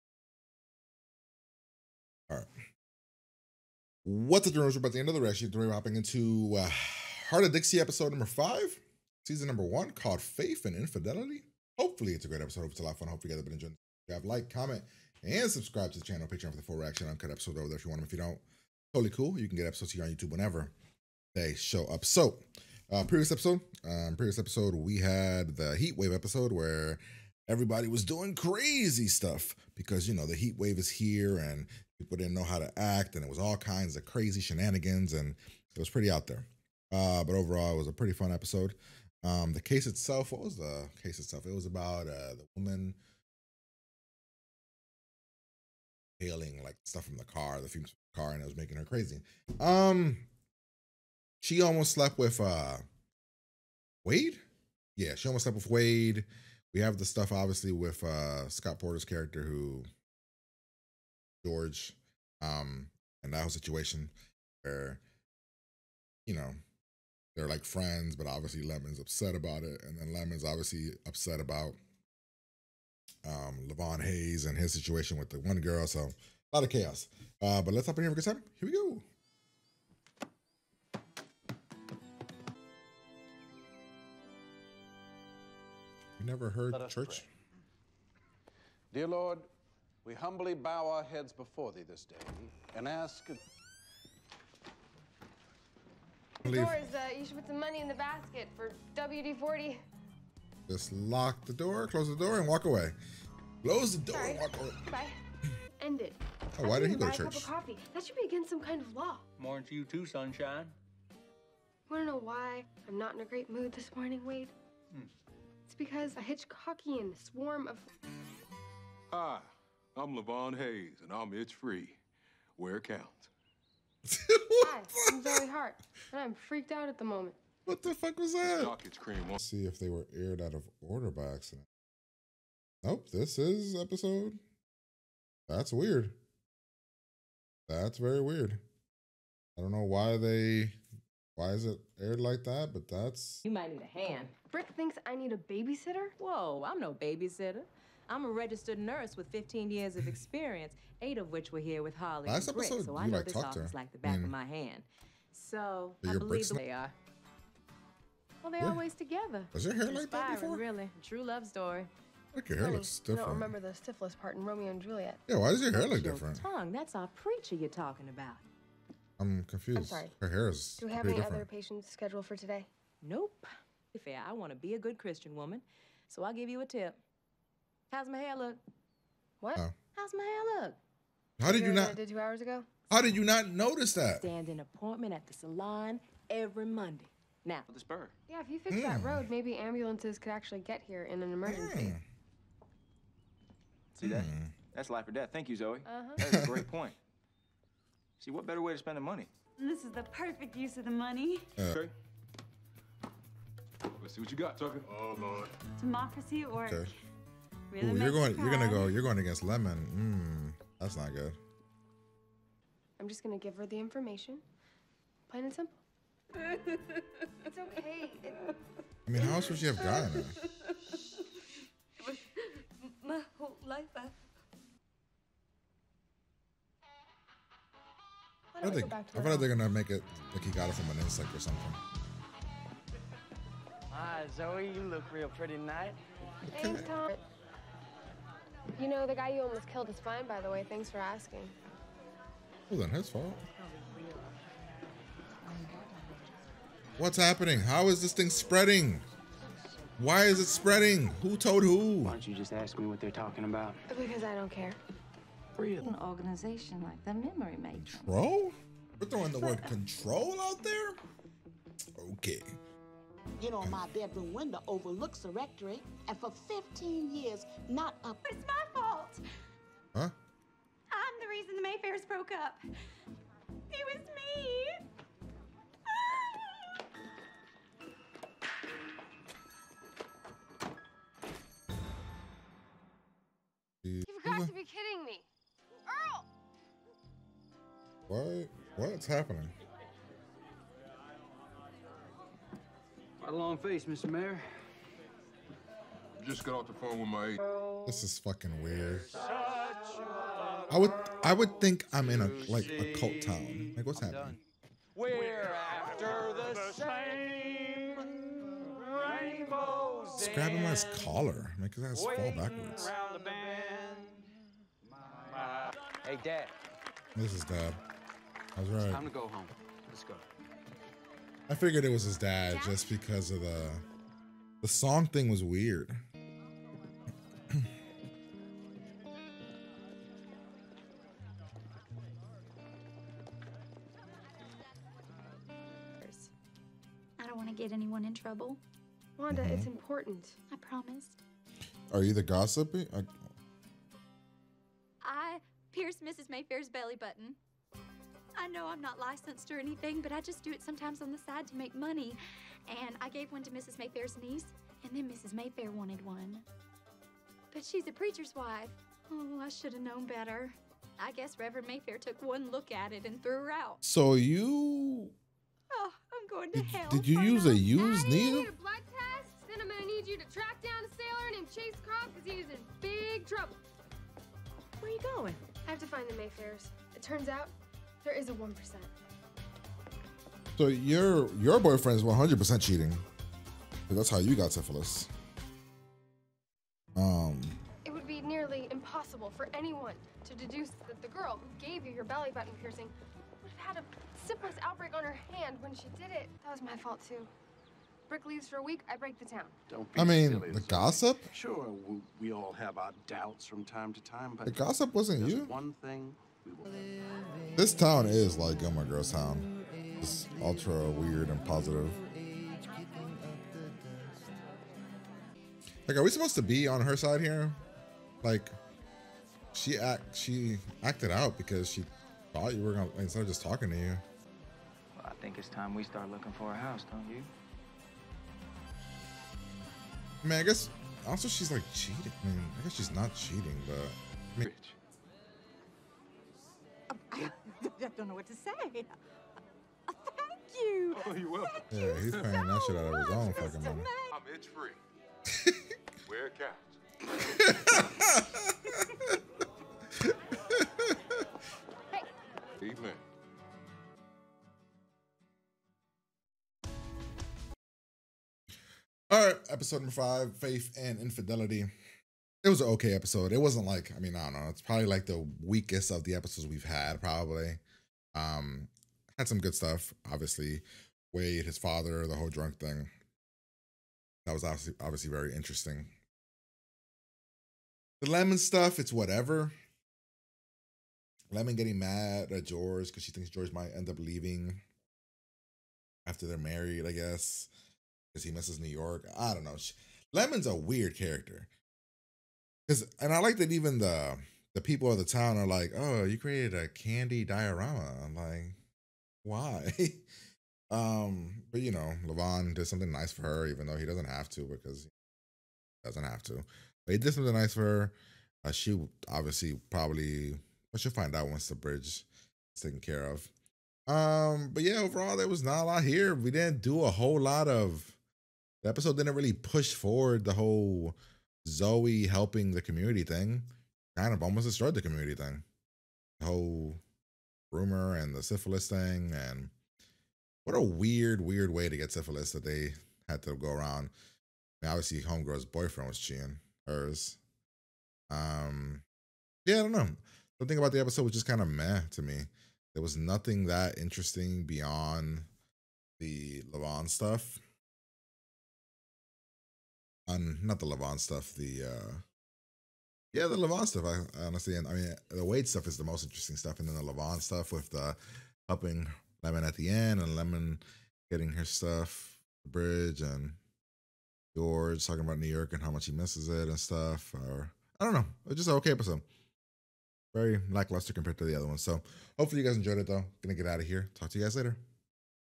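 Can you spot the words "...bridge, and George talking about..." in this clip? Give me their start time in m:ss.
9:22.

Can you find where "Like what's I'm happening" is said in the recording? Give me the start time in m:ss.
5:03.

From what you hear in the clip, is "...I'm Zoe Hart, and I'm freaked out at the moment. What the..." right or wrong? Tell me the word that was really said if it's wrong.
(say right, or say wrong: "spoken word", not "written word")
right.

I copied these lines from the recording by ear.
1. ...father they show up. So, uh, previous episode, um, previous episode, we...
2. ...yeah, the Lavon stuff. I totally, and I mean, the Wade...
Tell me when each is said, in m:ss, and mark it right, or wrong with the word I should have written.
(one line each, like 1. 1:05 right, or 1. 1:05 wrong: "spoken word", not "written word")
1. 0:20 wrong: "whenever", not "father"
2. 9:13 wrong: "honestly", not "totally".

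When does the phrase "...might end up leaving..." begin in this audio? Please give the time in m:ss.
8:03.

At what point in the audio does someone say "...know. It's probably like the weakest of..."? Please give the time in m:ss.
7:44.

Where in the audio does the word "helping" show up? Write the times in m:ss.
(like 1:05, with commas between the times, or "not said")
8:42, 9:18.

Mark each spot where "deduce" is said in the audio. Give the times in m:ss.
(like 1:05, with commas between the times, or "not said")
6:30.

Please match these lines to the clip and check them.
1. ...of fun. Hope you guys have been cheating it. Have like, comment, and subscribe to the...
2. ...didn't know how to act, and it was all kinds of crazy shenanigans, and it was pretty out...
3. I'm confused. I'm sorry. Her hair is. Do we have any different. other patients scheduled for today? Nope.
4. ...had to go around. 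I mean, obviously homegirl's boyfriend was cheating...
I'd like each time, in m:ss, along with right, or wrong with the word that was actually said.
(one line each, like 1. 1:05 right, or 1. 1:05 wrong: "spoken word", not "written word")
1. 0:12 wrong: "enjoying", not "cheating"
2. 0:32 right
3. 2:49 right
4. 8:53 right.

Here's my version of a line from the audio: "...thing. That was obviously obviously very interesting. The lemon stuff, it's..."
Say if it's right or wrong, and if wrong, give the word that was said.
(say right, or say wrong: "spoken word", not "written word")
right.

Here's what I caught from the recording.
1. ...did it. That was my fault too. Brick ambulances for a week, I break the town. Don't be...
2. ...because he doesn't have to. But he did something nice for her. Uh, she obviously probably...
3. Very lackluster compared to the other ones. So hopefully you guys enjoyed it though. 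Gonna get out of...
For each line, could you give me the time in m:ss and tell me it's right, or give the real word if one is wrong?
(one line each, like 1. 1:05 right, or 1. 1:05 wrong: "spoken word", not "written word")
1. 6:36 wrong: "leaves", not "ambulances"
2. 8:24 right
3. 9:30 right.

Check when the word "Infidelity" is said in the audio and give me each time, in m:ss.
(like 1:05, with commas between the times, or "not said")
0:10, 7:40.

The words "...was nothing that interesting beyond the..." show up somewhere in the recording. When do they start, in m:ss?
9:02.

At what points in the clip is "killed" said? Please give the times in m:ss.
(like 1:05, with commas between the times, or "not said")
3:59.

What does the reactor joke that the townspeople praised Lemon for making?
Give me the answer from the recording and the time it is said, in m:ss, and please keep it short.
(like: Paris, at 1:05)
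Candy diorama, at 8:16.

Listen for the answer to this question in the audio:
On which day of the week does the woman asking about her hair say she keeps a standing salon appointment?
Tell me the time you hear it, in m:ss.
3:06.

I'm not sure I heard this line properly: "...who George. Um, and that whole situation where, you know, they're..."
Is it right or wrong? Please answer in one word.
right.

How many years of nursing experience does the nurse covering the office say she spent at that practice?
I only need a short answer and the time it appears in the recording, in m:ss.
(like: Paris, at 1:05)
8, at 2:31.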